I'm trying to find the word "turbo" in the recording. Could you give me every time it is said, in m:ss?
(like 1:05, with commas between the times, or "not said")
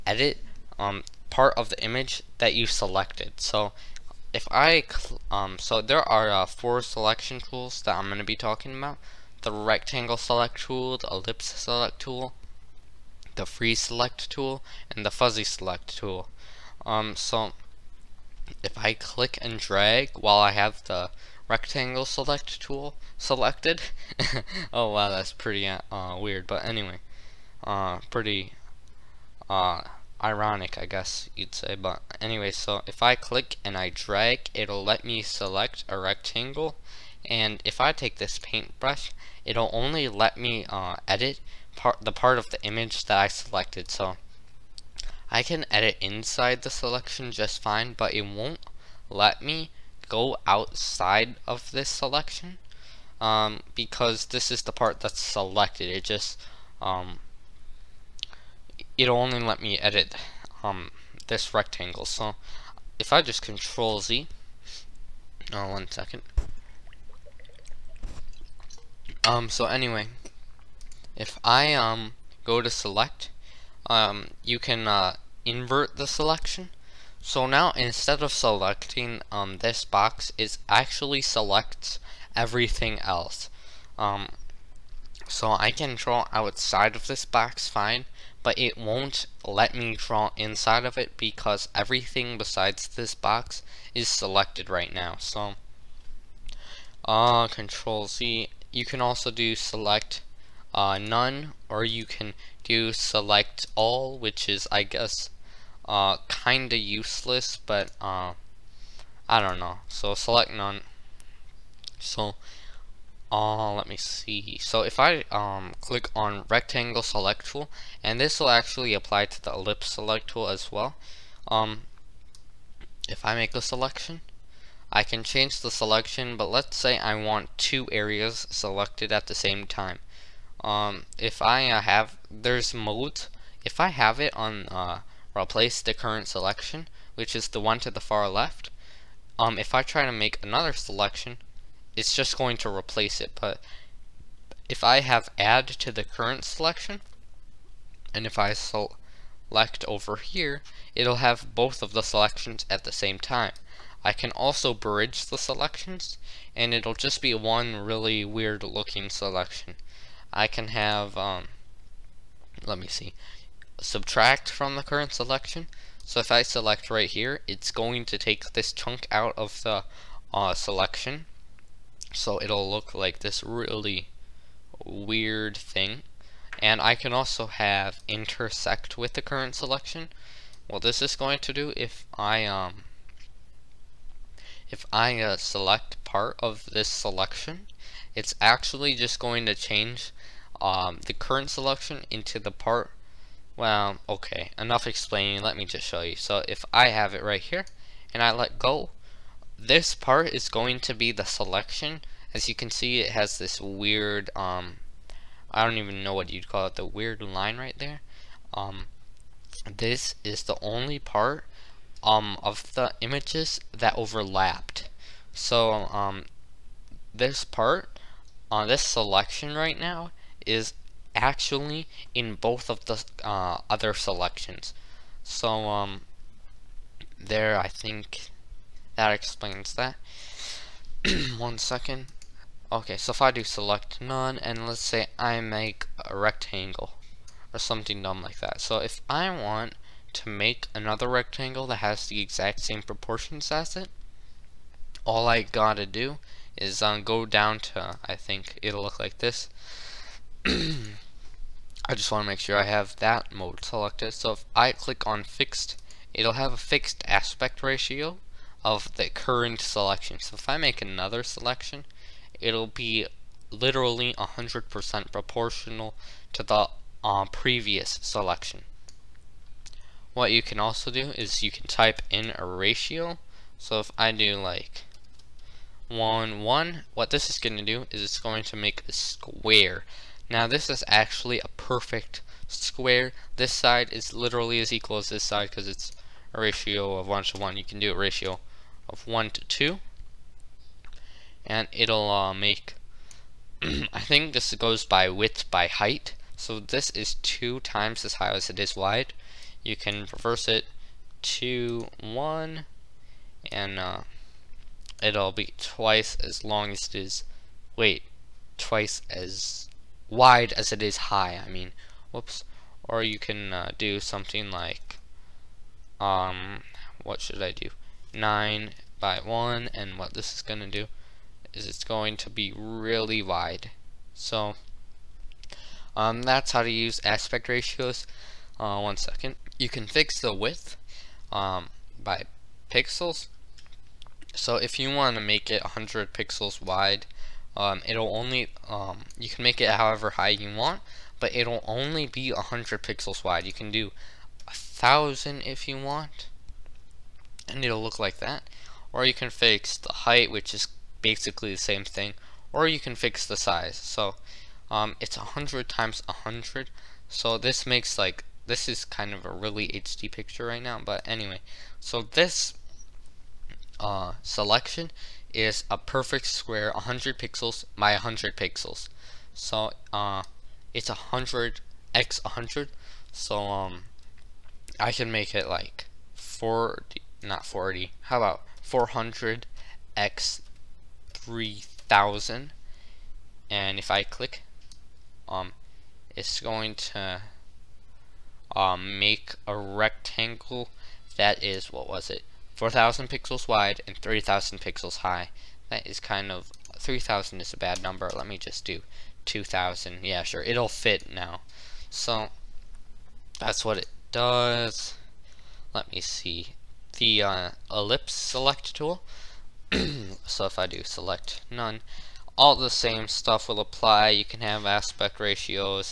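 not said.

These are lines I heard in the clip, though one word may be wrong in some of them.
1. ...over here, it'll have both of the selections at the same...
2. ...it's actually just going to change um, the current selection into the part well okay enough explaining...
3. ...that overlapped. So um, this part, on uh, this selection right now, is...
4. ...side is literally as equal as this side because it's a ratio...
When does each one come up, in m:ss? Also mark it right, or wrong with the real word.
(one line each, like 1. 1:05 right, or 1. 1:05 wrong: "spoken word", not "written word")
1. 2:29 right
2. 3:08 right
3. 3:33 right
4. 4:43 right.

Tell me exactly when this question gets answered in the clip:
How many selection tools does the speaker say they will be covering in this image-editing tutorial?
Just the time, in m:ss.
0:06.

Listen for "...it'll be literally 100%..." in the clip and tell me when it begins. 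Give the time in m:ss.
4:22.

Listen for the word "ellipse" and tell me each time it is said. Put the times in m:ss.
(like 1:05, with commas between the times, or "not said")
0:11, 1:59, 6:47.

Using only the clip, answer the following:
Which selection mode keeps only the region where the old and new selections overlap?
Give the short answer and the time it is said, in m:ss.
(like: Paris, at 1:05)
intersect with the current selection, at 2:58.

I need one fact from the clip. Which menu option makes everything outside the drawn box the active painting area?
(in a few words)
invert the selection.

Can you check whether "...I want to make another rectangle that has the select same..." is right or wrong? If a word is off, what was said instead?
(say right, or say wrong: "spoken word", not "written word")
wrong: "exact", not "select".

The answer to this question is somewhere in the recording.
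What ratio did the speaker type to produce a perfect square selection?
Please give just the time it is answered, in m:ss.
4:35.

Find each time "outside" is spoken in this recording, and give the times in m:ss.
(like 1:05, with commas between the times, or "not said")
0:50, 1:26.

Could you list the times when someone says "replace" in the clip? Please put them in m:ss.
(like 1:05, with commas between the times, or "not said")
2:15, 2:22.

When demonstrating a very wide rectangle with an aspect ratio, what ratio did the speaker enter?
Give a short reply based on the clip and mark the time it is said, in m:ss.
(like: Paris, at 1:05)
9 by 1, at 5:18.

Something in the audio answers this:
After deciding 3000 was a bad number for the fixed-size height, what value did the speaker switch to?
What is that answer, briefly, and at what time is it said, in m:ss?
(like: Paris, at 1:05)
2000, at 6:39.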